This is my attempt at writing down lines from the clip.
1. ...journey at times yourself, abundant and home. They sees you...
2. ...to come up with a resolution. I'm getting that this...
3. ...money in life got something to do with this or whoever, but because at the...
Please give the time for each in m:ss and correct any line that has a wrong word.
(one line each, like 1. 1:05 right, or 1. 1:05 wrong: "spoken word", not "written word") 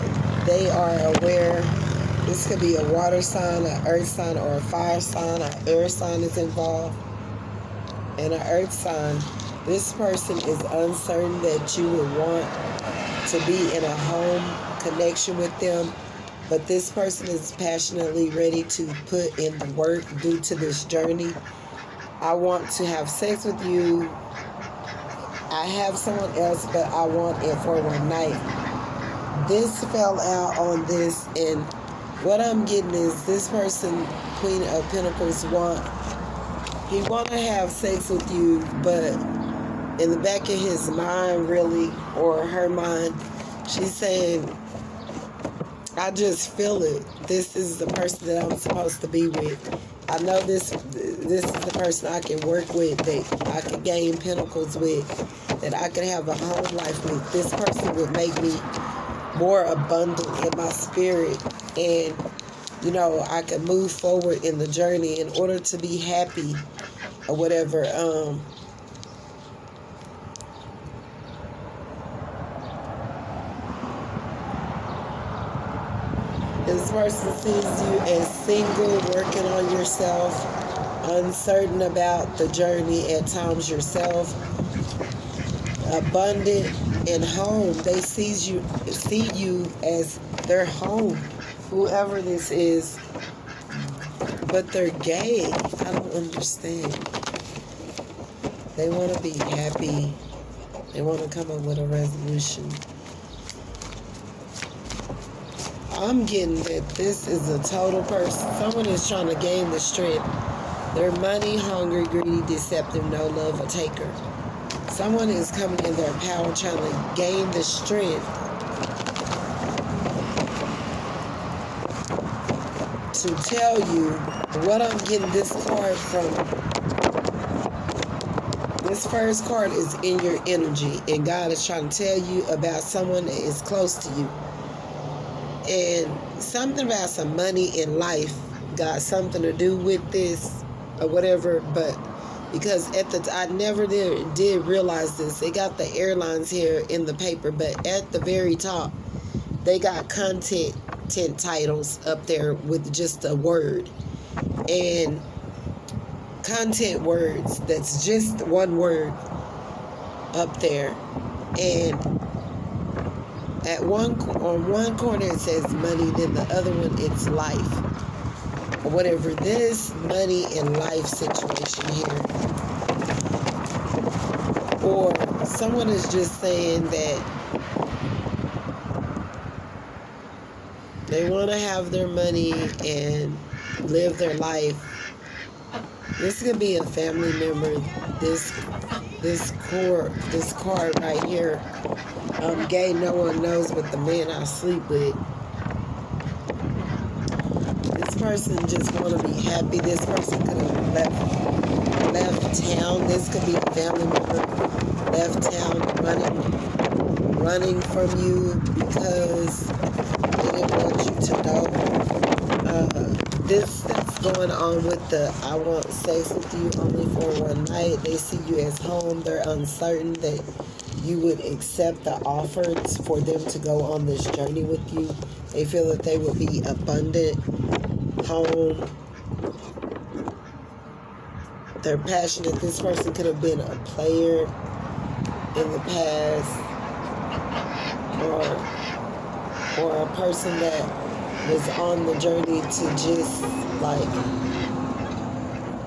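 1. 1:22 right
2. 1:41 right
3. 2:17 wrong: "whatever", not "whoever".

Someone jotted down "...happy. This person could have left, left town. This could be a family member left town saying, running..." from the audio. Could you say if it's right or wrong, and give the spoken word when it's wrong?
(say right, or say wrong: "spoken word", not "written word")
wrong: "running", not "saying".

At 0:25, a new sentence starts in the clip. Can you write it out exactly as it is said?
I have someone else, but I want it for one night.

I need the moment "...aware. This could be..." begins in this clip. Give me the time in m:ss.
0:01.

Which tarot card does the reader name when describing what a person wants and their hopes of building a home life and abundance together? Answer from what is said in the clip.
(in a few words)
Queen of Pentacles.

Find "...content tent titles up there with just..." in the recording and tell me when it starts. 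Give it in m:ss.
2:30.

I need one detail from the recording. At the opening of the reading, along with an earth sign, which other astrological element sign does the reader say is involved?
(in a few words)
Air sign.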